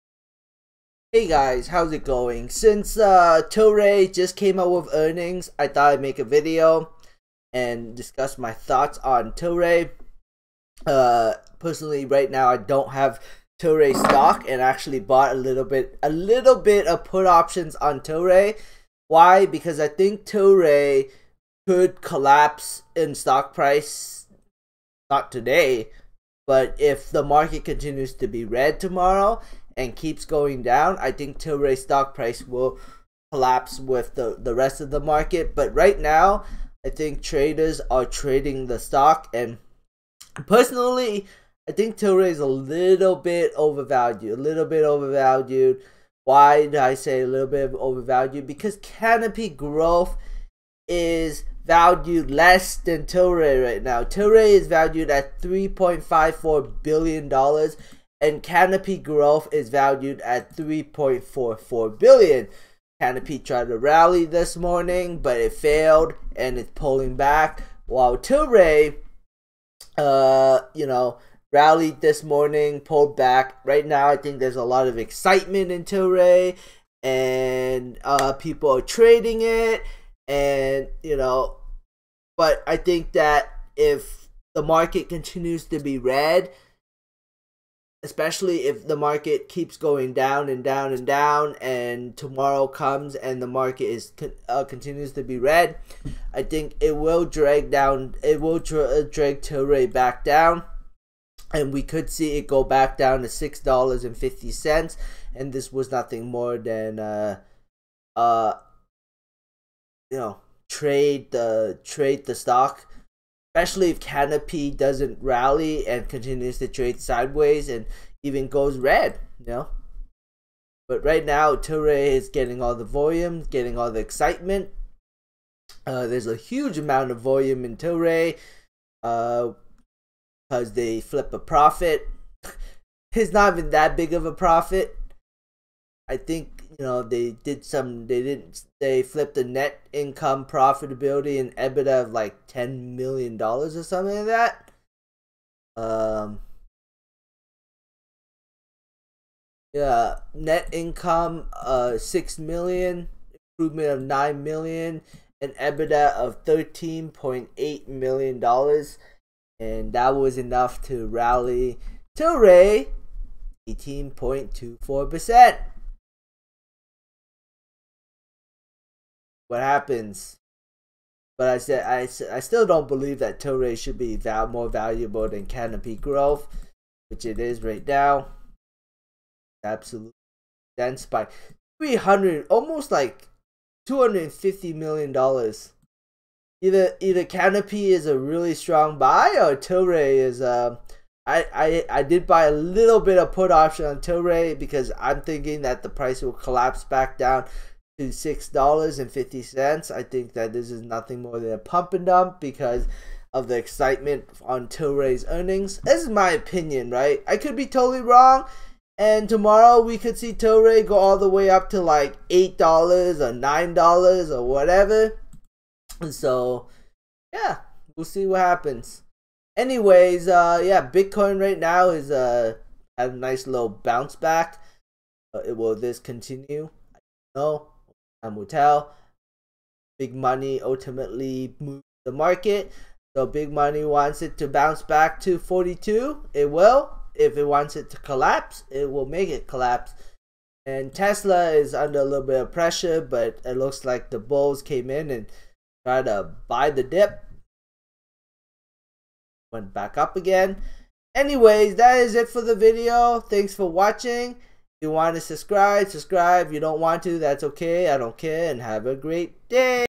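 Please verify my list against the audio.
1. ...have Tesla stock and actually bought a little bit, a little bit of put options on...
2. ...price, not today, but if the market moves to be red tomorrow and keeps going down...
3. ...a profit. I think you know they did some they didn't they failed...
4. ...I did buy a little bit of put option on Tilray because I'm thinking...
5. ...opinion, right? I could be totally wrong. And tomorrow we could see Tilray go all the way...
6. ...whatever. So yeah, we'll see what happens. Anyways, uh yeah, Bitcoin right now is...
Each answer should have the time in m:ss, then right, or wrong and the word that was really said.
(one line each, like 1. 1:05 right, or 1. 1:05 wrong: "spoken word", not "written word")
1. 0:12 wrong: "Tilray", not "Tesla"
2. 0:23 wrong: "continues", not "moves"
3. 2:14 wrong: "flipped", not "failed"
4. 3:11 right
5. 3:26 right
6. 3:34 right.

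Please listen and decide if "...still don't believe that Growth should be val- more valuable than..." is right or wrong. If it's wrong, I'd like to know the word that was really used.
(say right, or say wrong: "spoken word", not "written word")
wrong: "Tilray", not "Growth".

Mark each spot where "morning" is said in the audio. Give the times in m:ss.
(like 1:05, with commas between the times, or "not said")
1:04, 1:12.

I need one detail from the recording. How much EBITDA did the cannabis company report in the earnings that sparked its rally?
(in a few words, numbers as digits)
$13.8 million.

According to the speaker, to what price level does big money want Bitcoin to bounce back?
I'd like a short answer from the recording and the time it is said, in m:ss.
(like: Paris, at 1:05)
42, at 3:55.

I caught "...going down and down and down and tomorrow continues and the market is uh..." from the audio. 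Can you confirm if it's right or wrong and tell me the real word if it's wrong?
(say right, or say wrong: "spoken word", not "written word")
wrong: "comes", not "continues".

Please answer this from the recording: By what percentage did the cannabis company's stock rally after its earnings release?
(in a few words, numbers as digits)
18.24%.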